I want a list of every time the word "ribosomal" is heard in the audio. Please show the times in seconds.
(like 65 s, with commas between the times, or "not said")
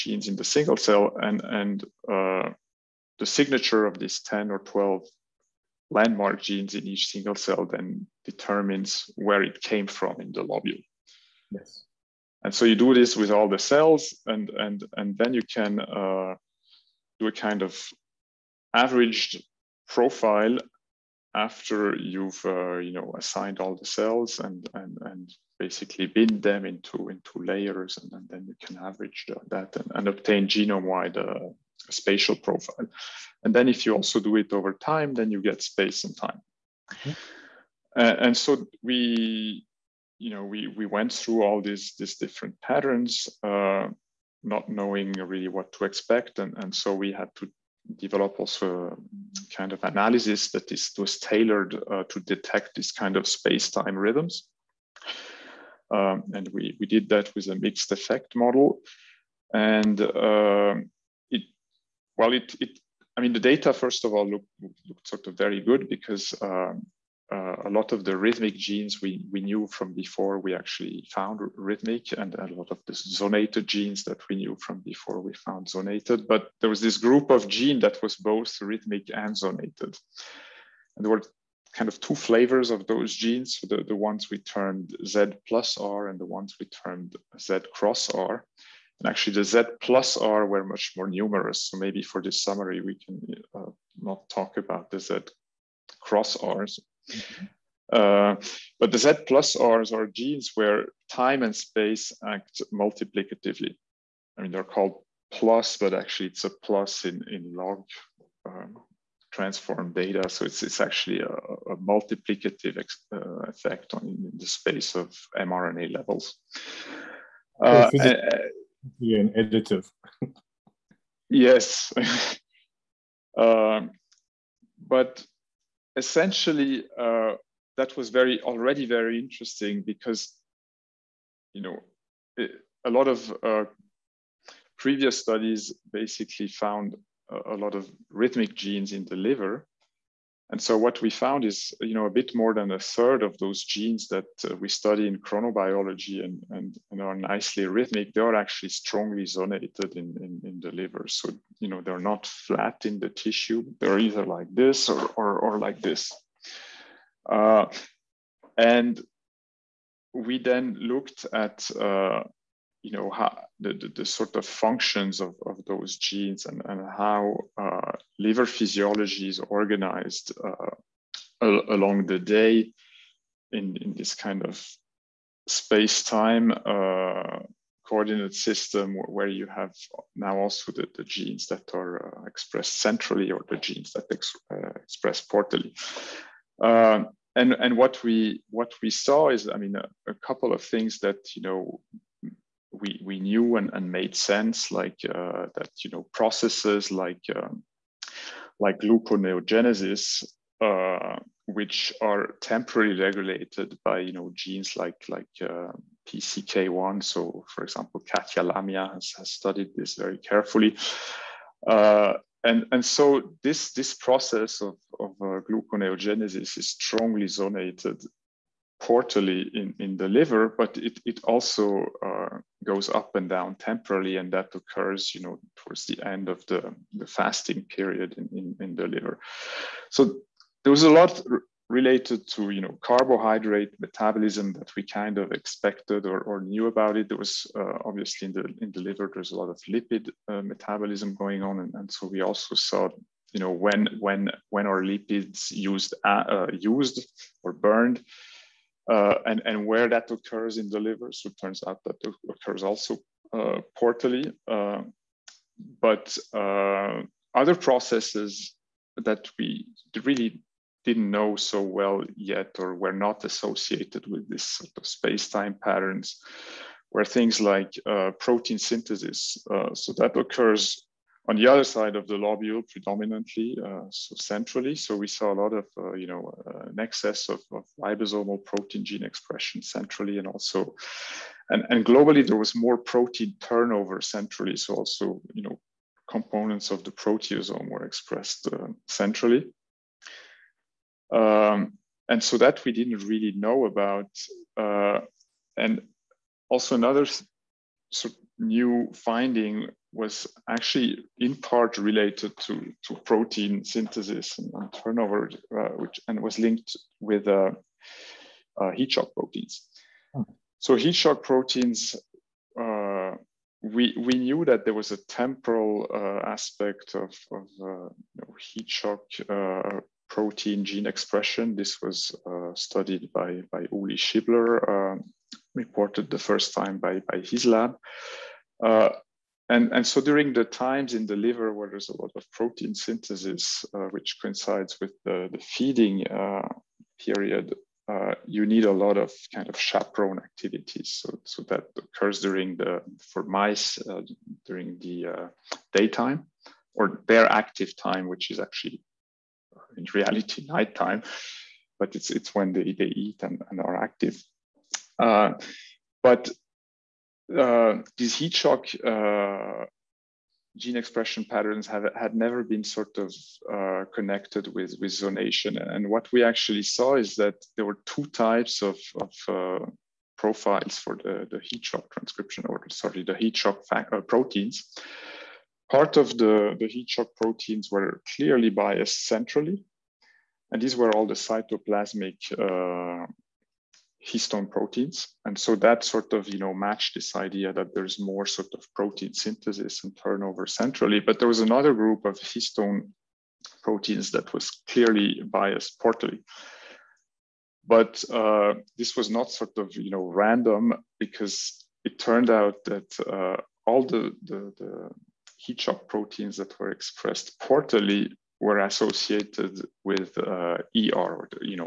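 277 s.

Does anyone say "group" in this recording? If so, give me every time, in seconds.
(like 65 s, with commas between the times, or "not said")
76 s, 391 s.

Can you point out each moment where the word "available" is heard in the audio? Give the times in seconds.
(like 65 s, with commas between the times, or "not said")
not said.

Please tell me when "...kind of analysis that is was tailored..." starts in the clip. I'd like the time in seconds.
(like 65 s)
49 s.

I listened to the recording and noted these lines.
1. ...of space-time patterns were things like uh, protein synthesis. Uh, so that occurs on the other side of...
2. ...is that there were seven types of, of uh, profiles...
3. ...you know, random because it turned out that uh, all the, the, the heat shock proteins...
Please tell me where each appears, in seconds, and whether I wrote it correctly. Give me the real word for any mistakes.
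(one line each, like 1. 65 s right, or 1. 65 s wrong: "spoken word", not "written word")
1. 264 s right
2. 366 s wrong: "two", not "seven"
3. 399 s right.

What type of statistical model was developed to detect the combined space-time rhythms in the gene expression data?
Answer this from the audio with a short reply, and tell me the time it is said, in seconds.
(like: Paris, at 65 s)
mixed effect model, at 57 s.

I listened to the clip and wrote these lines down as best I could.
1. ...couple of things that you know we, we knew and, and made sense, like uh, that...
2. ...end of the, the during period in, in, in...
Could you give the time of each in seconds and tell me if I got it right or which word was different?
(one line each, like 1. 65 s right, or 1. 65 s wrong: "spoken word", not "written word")
1. 190 s right
2. 226 s wrong: "fasting", not "during".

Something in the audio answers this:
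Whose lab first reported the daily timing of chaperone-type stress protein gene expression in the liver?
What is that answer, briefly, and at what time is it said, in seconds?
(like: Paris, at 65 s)
Uli Schibler, at 323 s.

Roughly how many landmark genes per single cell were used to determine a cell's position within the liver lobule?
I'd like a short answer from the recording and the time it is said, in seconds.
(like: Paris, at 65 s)
10 or 12, at 4 s.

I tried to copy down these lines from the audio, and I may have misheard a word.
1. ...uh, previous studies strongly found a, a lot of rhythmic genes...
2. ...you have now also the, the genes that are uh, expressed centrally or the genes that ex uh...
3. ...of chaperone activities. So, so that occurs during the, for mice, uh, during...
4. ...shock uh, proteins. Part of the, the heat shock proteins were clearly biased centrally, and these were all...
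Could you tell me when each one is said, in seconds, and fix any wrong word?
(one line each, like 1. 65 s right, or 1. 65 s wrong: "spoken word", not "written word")
1. 133 s wrong: "basically", not "strongly"
2. 179 s right
3. 339 s right
4. 373 s right.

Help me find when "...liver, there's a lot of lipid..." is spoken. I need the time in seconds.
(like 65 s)
238 s.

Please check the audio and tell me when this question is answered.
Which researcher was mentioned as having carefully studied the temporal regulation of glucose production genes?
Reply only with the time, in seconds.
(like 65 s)
208 s.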